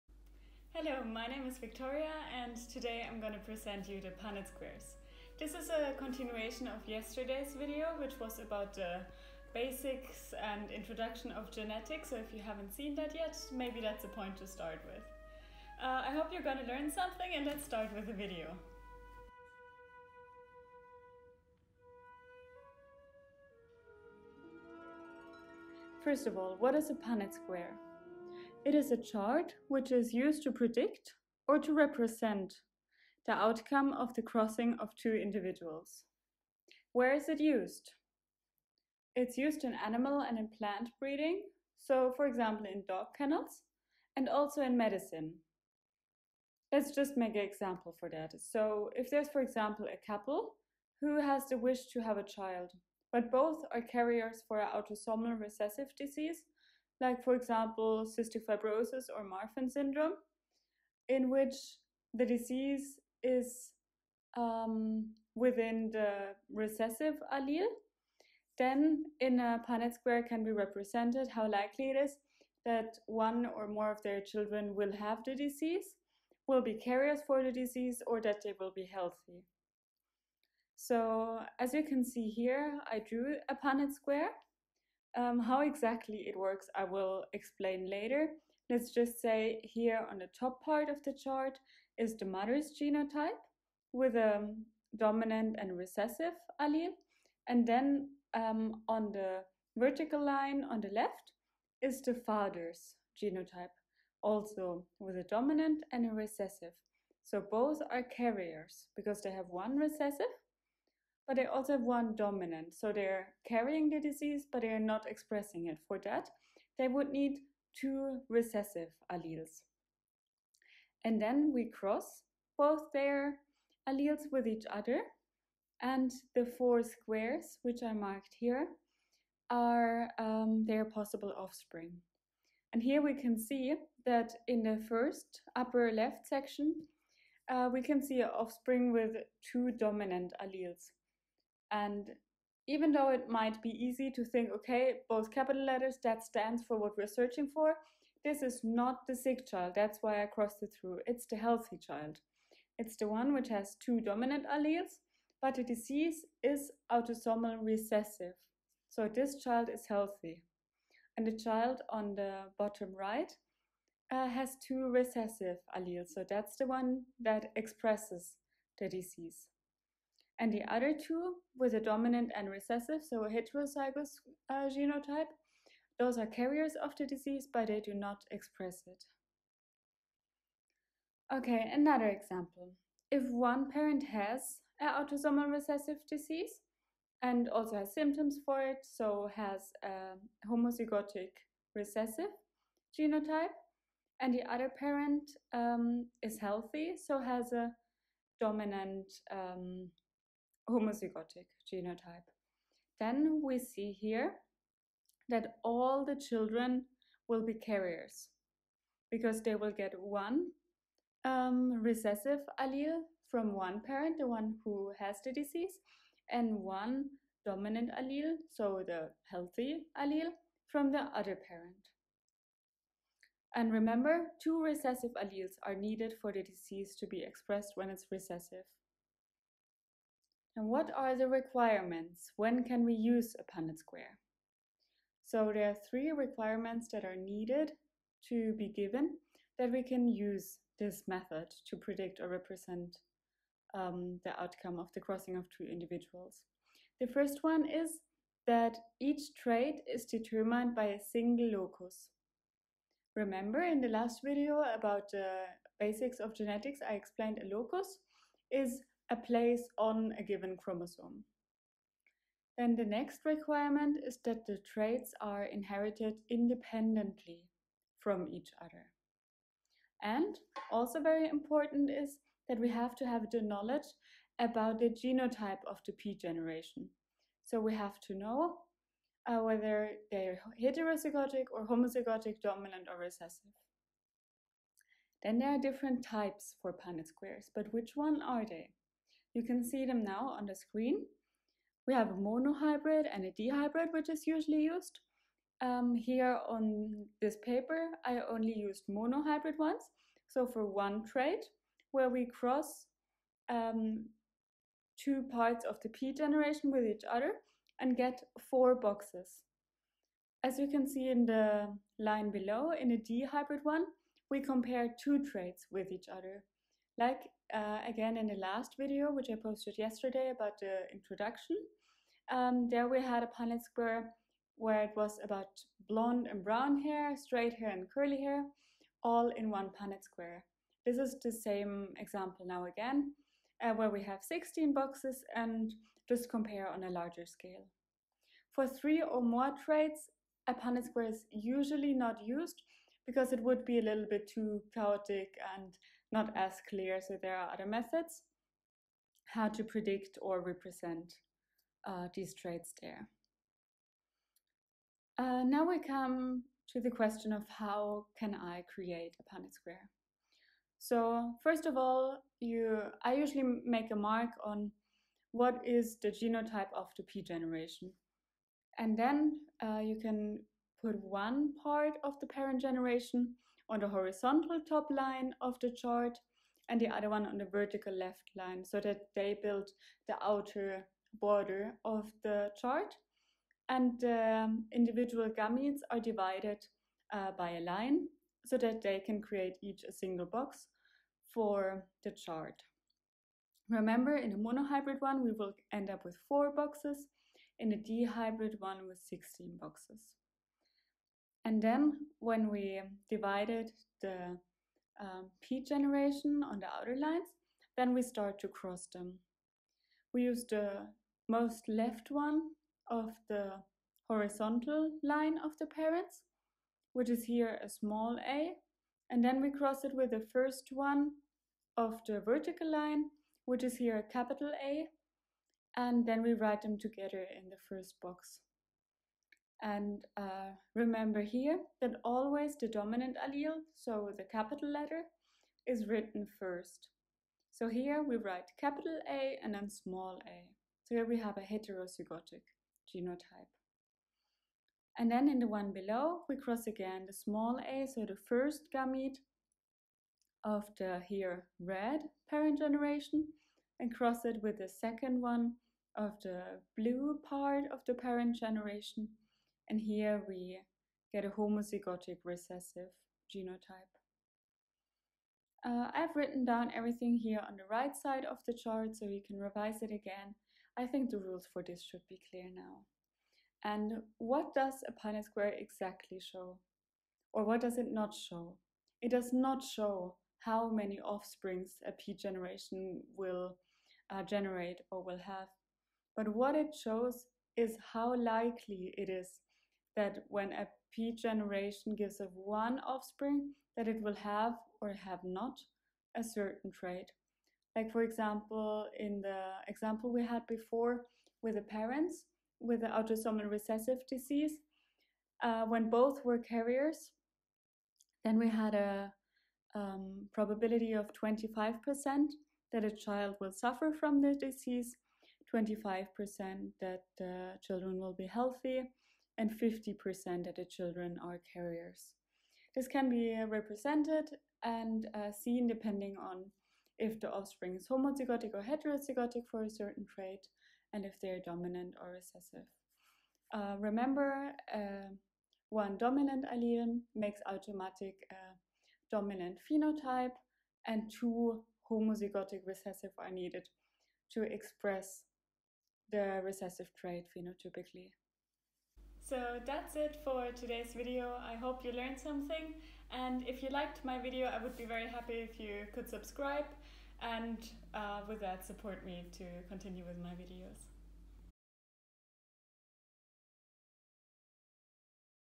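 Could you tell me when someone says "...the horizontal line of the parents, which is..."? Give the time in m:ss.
6:53.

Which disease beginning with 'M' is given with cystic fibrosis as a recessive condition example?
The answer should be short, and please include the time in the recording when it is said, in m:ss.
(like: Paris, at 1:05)
Marfan syndrome, at 0:59.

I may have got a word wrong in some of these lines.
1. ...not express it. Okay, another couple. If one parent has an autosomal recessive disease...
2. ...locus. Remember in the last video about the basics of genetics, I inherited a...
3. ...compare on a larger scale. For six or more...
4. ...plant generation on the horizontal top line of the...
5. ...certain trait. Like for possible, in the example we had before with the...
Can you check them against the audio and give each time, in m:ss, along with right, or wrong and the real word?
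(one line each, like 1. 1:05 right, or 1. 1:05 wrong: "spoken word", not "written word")
1. 2:57 wrong: "example", not "couple"
2. 4:11 wrong: "explained", not "inherited"
3. 5:36 wrong: "three", not "six"
4. 6:12 wrong: "parent", not "plant"
5. 8:16 wrong: "example", not "possible".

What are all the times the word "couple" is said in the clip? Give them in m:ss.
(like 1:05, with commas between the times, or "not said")
0:50.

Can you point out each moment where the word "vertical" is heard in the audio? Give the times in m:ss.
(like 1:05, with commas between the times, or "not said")
1:39, 6:17, 7:02.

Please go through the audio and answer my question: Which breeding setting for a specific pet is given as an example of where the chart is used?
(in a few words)
dog kennels.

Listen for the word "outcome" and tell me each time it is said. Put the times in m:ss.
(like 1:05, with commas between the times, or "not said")
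0:33, 4:04.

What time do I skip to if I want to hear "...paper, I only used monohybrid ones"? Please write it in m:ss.
4:57.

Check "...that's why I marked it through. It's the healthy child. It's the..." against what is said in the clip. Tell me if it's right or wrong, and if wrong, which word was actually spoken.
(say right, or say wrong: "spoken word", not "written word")
wrong: "crossed", not "marked".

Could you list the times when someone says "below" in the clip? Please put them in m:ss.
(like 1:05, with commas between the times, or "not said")
5:12, 7:25.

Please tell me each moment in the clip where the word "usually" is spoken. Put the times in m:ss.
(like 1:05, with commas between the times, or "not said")
4:54, 5:41, 6:03.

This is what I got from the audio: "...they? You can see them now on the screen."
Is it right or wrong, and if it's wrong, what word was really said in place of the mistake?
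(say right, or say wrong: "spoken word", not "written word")
right.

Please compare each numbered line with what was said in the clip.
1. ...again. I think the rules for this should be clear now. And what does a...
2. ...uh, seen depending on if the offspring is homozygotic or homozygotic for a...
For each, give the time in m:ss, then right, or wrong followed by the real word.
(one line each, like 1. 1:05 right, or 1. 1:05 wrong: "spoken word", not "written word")
1. 7:49 right
2. 8:45 wrong: "heterozygotic", not "homozygotic".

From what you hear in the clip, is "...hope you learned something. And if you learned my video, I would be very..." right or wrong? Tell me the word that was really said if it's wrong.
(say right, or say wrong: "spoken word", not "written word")
wrong: "liked", not "learned".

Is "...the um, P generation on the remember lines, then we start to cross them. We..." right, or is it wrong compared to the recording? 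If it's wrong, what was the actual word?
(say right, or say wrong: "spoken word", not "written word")
wrong: "outer", not "remember".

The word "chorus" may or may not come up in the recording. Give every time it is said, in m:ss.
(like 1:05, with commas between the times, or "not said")
not said.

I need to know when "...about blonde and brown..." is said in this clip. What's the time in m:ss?
5:25.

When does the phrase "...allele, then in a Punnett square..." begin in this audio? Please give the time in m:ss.
1:07.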